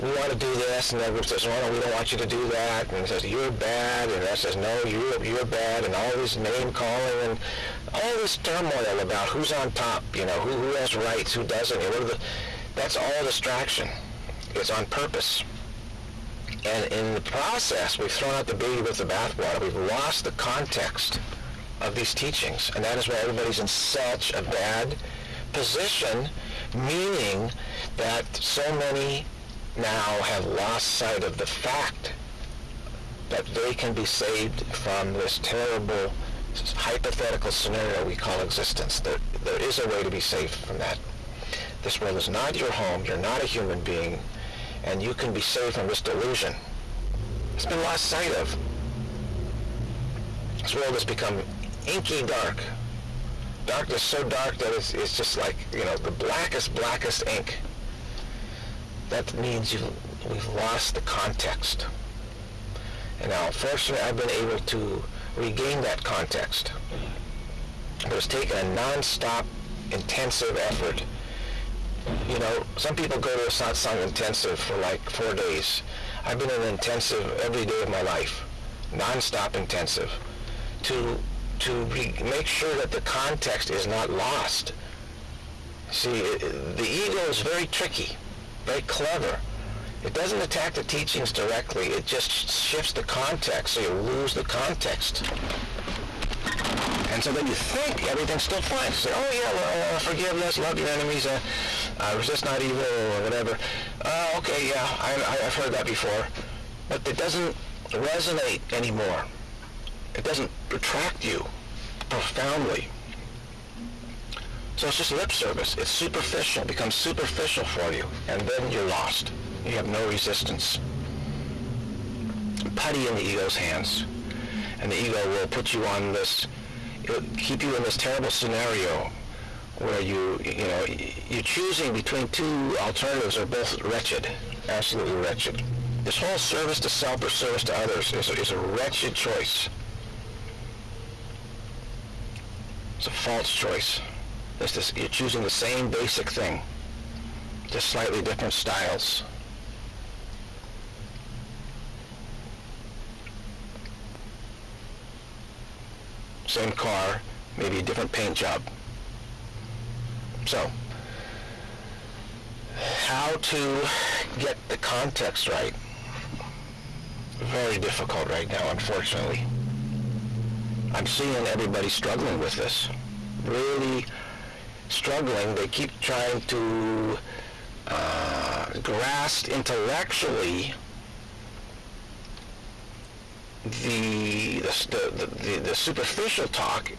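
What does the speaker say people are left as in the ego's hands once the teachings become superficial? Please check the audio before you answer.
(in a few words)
putty.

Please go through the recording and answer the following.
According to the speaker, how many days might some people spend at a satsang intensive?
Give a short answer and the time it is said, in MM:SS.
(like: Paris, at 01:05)
4 days, at 01:15.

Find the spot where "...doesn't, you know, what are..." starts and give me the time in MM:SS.
00:11.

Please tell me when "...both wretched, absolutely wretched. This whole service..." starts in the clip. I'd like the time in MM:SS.
02:13.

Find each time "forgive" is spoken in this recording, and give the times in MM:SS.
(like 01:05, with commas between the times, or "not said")
01:39.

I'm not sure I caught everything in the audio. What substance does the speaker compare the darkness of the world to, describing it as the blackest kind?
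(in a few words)
ink.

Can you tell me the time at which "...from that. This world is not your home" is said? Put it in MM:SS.
00:40.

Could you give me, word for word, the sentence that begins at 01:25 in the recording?
See, it, the ego is very tricky, very clever.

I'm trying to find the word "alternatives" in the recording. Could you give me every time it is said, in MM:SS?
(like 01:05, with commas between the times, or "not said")
02:12.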